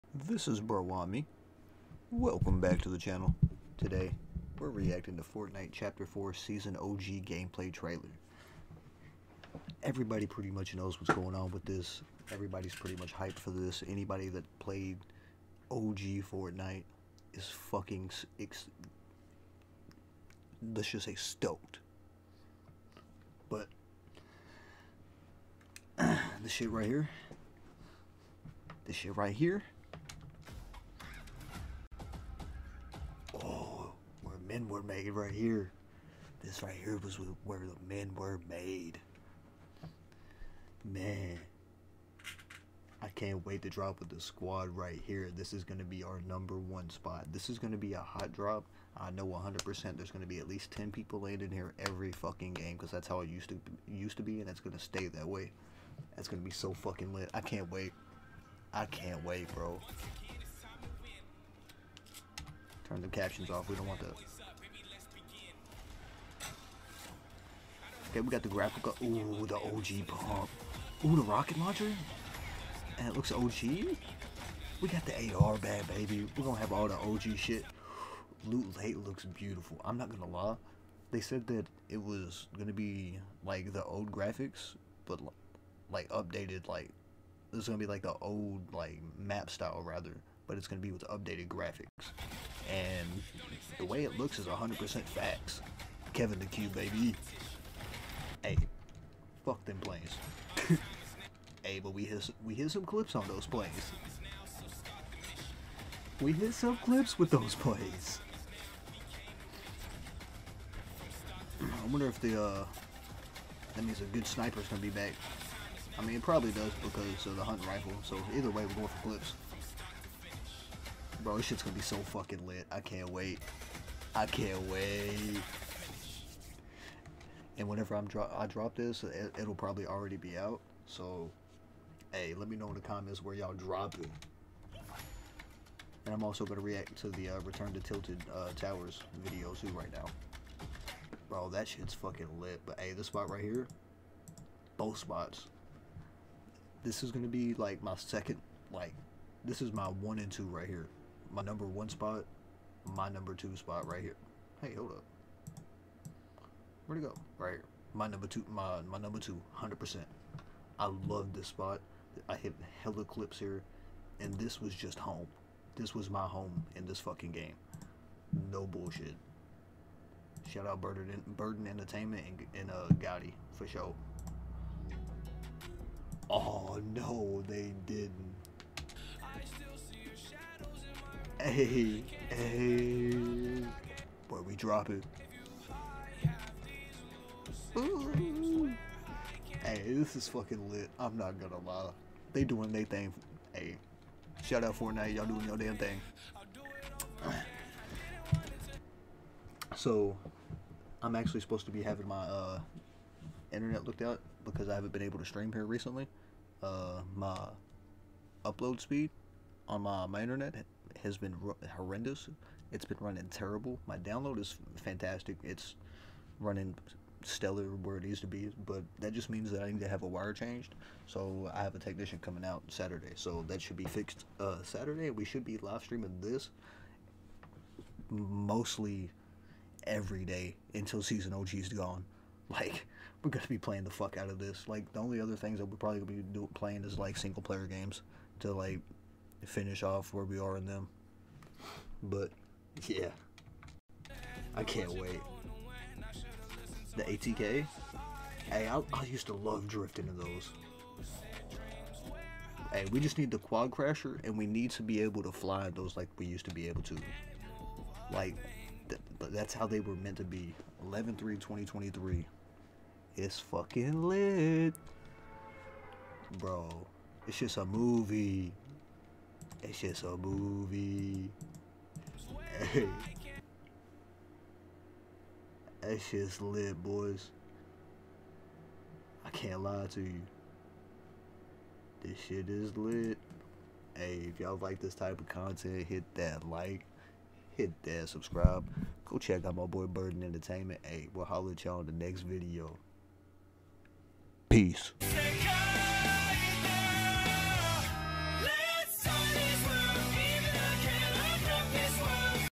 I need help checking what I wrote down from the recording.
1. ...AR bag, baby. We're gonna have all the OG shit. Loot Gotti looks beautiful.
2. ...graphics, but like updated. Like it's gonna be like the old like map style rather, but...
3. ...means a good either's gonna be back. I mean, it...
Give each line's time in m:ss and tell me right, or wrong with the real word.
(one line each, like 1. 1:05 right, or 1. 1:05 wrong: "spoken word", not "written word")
1. 1:15 wrong: "Lake", not "Gotti"
2. 1:24 right
3. 1:53 wrong: "sniper", not "either".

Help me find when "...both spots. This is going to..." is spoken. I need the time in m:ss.
2:24.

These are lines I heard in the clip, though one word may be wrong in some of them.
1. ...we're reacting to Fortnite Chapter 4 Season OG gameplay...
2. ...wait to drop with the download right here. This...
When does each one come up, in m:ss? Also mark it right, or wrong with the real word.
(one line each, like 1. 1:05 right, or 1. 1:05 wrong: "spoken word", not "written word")
1. 0:04 right
2. 0:43 wrong: "squad", not "download".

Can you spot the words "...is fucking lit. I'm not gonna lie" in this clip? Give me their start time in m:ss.
3:10.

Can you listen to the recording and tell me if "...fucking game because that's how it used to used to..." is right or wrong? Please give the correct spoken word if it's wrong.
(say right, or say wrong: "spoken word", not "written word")
right.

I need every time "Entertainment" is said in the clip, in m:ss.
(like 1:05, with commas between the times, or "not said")
2:51, 4:50.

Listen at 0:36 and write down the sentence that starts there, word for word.
This right here was where the men were made.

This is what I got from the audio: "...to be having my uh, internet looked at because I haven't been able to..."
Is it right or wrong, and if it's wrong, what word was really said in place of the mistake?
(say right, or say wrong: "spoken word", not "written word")
right.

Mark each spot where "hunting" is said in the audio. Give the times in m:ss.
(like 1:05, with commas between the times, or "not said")
1:57.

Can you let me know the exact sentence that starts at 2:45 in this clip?
This was my home in this fucking game.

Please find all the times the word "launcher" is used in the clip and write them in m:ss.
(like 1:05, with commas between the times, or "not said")
1:11.